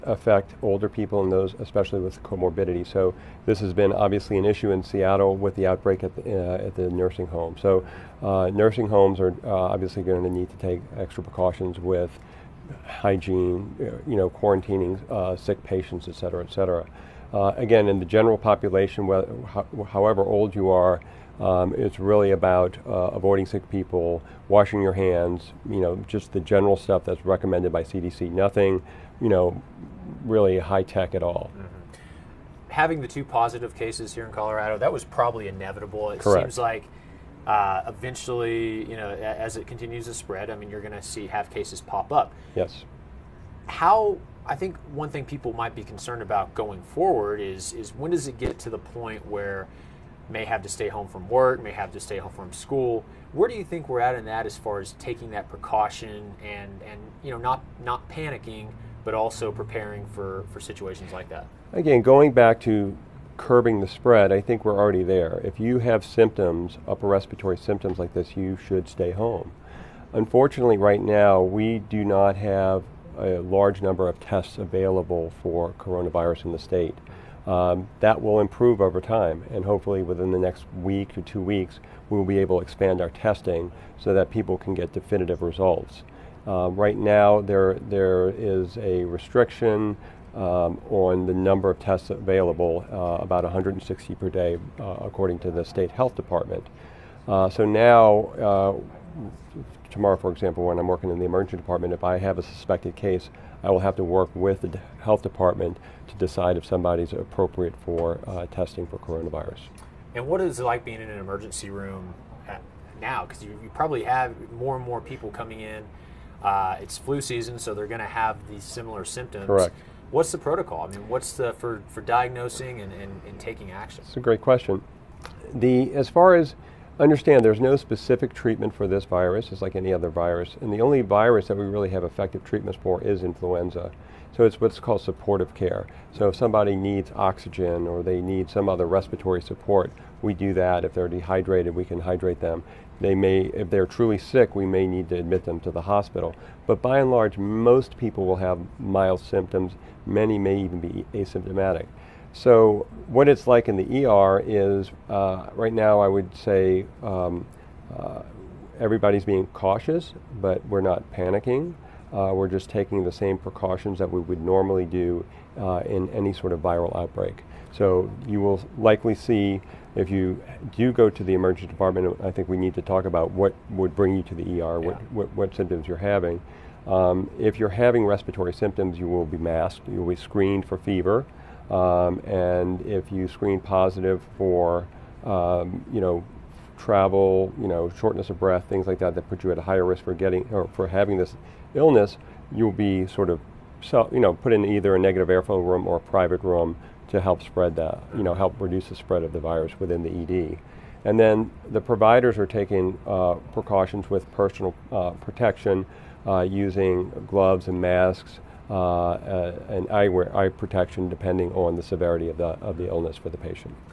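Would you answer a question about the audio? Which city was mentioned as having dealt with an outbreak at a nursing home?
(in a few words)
Seattle.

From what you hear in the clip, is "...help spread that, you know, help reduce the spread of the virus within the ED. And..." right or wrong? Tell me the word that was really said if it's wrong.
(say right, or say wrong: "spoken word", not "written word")
right.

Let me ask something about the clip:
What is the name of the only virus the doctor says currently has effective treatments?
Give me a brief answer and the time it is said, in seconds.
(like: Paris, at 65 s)
influenza, at 133 s.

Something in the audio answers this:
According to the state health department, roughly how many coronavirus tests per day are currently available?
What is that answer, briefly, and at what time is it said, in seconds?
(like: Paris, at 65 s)
160, at 93 s.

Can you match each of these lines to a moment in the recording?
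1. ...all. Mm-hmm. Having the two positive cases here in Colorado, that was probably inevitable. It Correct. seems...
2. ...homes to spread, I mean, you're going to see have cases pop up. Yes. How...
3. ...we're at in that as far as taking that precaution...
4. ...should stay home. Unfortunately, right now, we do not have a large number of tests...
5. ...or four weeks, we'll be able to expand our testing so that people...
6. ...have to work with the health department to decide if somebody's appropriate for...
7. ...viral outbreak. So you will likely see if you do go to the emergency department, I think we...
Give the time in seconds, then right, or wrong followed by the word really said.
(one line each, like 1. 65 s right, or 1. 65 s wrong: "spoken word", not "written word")
1. 31 s right
2. 39 s wrong: "continues", not "homes"
3. 53 s right
4. 68 s right
5. 81 s wrong: "two", not "four"
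6. 103 s right
7. 166 s right.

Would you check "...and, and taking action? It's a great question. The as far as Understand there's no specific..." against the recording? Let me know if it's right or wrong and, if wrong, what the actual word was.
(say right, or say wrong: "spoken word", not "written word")
right.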